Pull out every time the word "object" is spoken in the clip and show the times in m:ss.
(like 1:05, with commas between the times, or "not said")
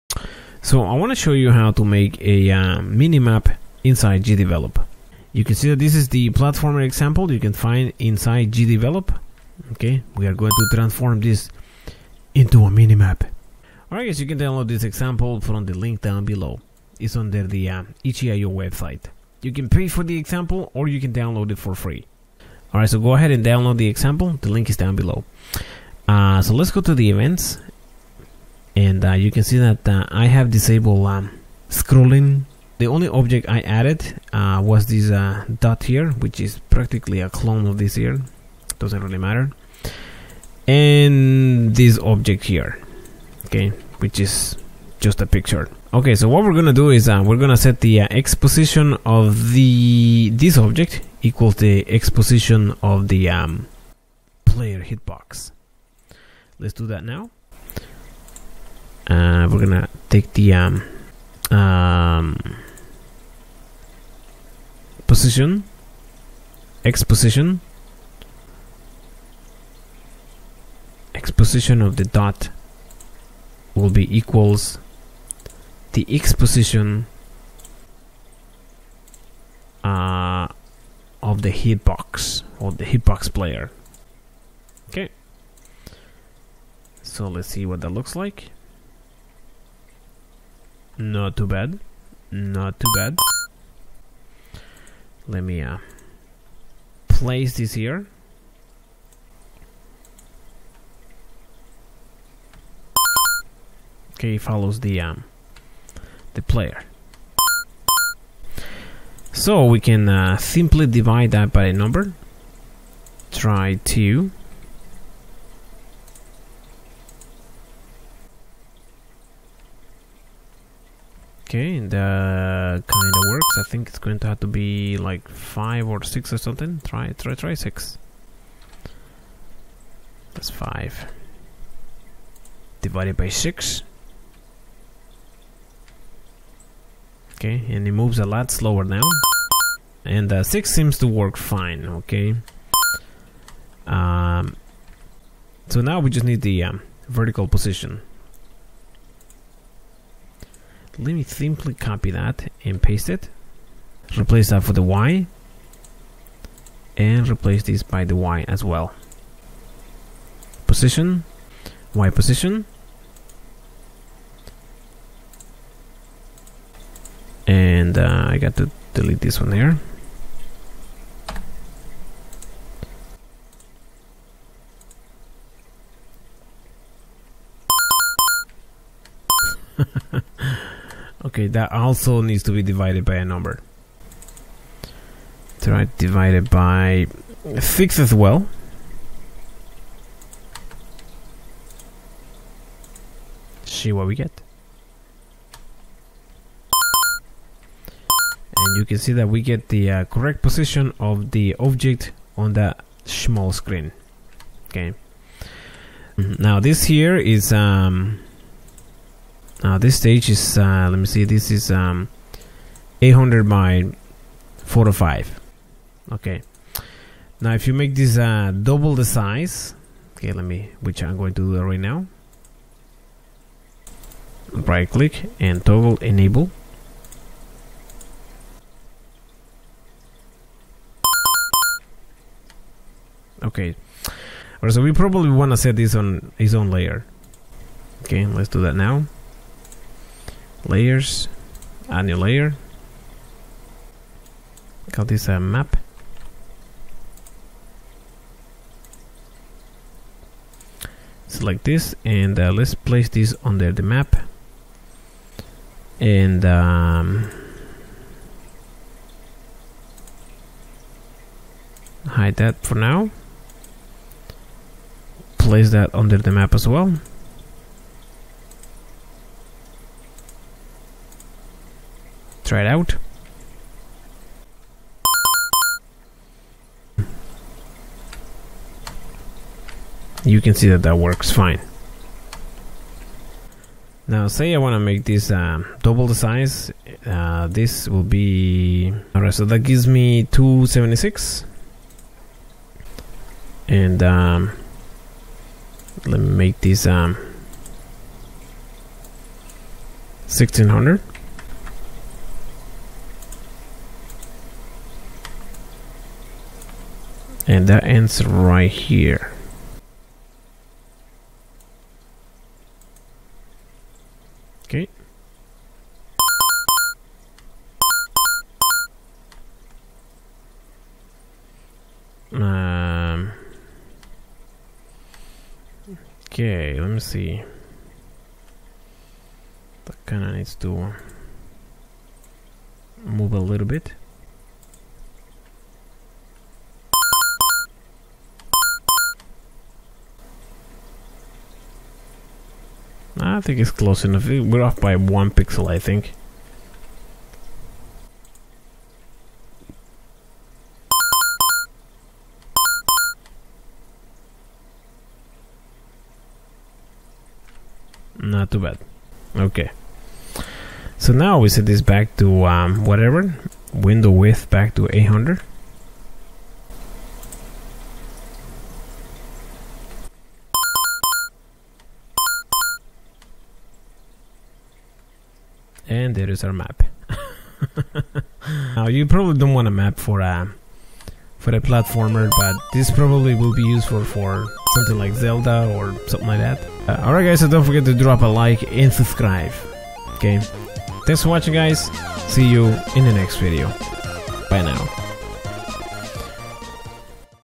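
0:33, 0:41, 0:50, 3:21.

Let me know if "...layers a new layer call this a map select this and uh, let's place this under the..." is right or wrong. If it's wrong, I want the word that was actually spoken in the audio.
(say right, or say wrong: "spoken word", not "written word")
right.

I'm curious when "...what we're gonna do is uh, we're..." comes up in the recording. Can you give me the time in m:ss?
0:46.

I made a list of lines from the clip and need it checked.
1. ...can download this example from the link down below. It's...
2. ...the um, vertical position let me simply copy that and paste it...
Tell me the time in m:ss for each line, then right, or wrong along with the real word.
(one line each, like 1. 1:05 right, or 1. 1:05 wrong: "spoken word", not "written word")
1. 0:14 right
2. 2:26 right.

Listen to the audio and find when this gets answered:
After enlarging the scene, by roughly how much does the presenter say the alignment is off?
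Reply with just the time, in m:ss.
5:44.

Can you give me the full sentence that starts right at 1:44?
Okay, follows the um, the player.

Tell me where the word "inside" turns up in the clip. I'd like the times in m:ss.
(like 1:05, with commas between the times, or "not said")
0:03, 0:07.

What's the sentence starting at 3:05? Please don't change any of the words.
Try divided by 6 as well.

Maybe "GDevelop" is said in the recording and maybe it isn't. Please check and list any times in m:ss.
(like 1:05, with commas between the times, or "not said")
0:04, 0:08.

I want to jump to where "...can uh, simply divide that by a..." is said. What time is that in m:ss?
1:49.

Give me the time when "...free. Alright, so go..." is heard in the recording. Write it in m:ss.
0:21.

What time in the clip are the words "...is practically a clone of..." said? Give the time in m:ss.
0:36.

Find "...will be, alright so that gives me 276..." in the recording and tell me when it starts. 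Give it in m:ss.
4:47.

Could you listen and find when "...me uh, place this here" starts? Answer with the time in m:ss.
1:35.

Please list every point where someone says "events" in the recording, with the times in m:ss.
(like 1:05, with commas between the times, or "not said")
0:27.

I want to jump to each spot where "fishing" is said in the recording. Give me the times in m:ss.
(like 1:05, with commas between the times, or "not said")
not said.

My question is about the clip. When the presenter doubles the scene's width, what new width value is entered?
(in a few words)
1600.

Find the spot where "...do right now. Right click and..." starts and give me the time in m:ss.
3:41.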